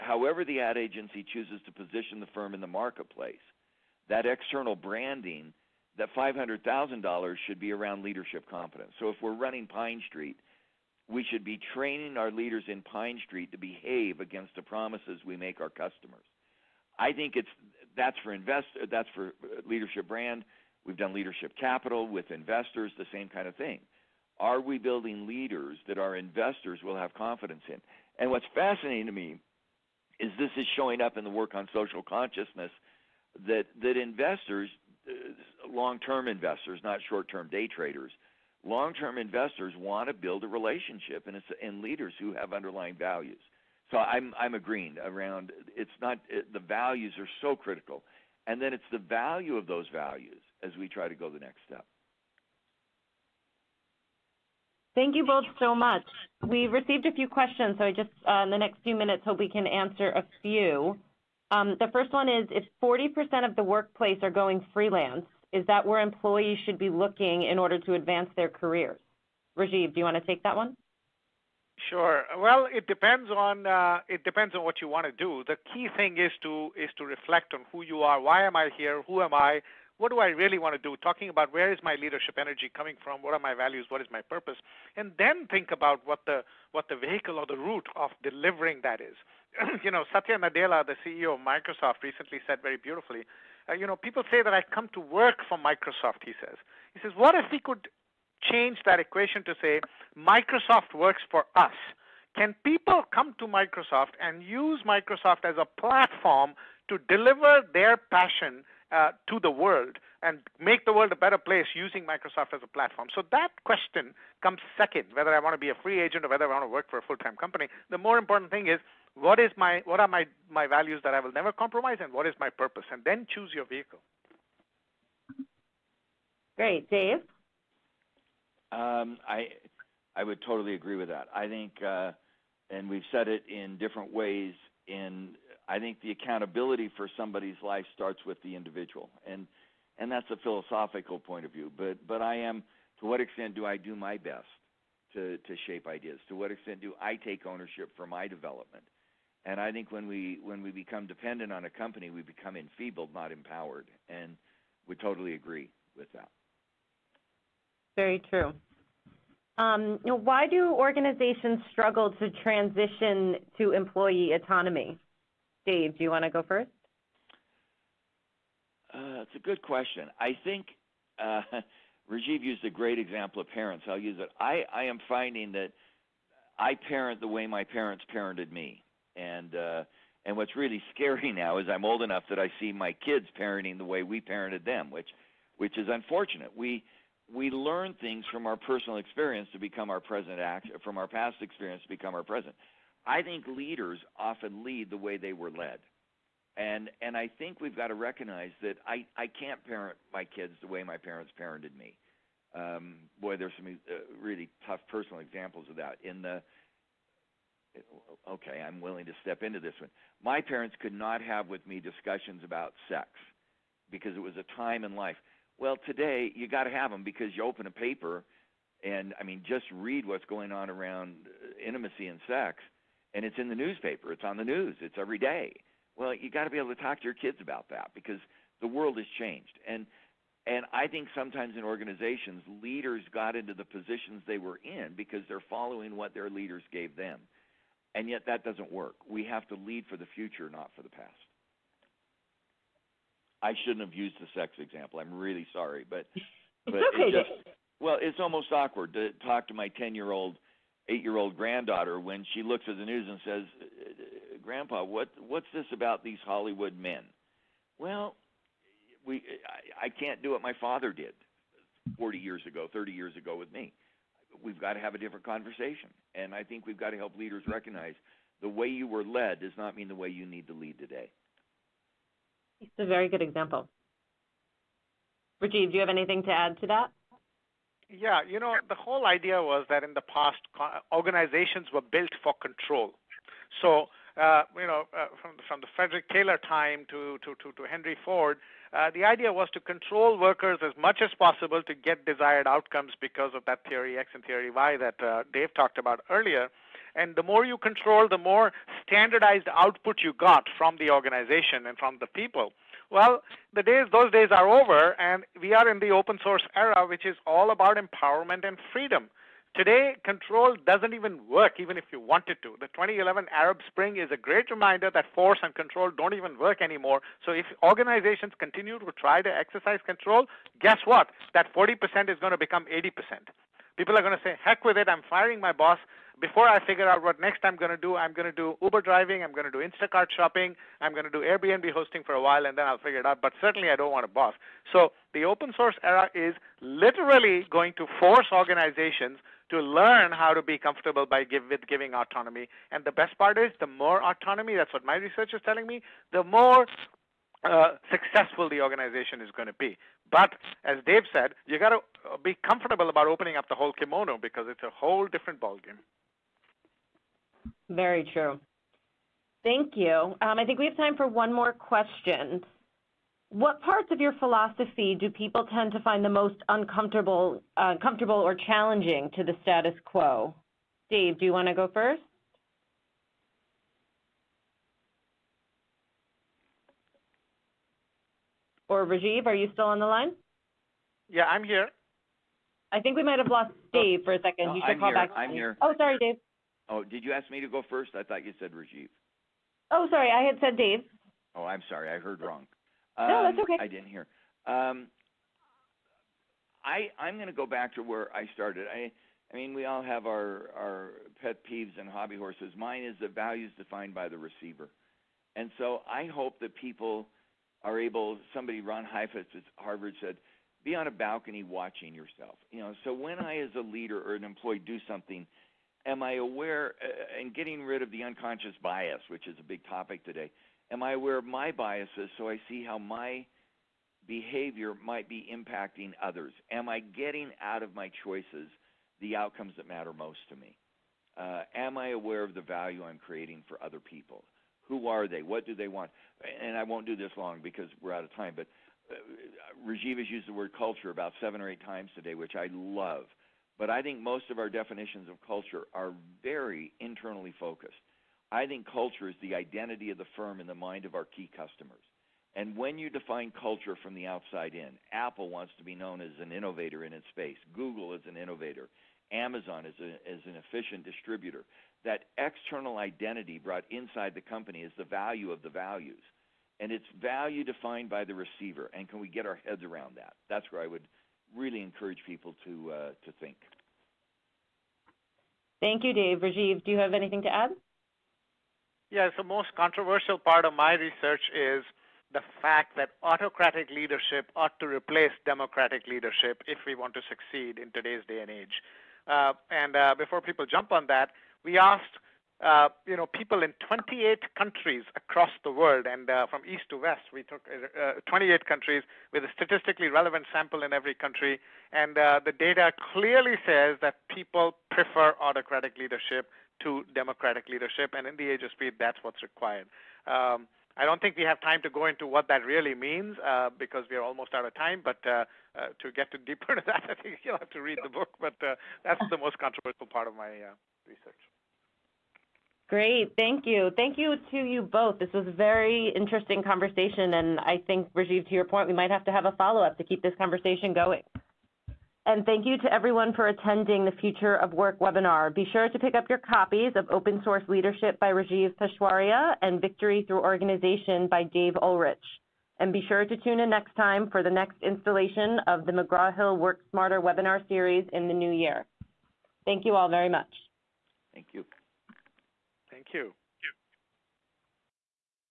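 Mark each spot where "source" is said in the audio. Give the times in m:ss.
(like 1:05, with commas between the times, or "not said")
5:06, 5:35, 8:57.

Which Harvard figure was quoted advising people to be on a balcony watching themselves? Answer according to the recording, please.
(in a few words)
Ron Heifetz.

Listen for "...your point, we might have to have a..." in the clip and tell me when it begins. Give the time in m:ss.
8:48.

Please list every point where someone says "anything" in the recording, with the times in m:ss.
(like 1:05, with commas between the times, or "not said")
4:35, 7:56.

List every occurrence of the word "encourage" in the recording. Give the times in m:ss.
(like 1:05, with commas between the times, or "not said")
7:51.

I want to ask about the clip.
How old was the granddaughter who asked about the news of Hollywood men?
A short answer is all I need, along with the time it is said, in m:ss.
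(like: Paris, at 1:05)
8, at 4:10.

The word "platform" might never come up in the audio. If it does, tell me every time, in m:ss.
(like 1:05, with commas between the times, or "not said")
1:45, 1:52.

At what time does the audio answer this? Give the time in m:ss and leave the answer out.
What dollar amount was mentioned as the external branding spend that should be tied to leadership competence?
0:06.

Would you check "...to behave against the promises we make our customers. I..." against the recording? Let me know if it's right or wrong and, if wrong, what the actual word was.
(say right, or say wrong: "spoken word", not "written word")
right.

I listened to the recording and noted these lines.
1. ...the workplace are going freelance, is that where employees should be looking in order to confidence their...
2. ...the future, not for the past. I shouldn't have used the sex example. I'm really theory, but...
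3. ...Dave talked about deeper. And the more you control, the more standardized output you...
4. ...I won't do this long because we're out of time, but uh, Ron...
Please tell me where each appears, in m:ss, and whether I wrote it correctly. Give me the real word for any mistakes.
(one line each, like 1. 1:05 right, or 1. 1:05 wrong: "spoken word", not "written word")
1. 1:03 wrong: "advance", not "confidence"
2. 3:59 wrong: "sorry", not "theory"
3. 4:55 wrong: "earlier", not "deeper"
4. 7:16 wrong: "Rajeev", not "Ron".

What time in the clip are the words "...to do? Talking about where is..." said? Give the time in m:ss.
1:20.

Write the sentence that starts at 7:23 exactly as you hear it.
But I think most of our definitions of culture are very internally focused.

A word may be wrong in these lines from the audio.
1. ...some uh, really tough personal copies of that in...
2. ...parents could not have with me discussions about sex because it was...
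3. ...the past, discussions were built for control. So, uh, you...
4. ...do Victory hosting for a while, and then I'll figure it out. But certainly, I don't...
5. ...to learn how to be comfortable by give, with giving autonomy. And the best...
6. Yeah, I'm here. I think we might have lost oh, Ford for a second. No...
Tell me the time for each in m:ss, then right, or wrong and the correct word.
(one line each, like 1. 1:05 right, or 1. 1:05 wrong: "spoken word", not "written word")
1. 3:23 wrong: "examples", not "copies"
2. 3:30 right
3. 4:39 wrong: "organizations", not "discussions"
4. 5:31 wrong: "Airbnb", not "Victory"
5. 5:39 right
6. 6:21 wrong: "Dave", not "Ford".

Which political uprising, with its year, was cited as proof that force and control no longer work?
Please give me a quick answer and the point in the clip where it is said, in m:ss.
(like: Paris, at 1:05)
2011 Arab Spring, at 5:12.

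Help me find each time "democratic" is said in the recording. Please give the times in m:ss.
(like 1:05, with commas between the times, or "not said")
8:05, 8:26.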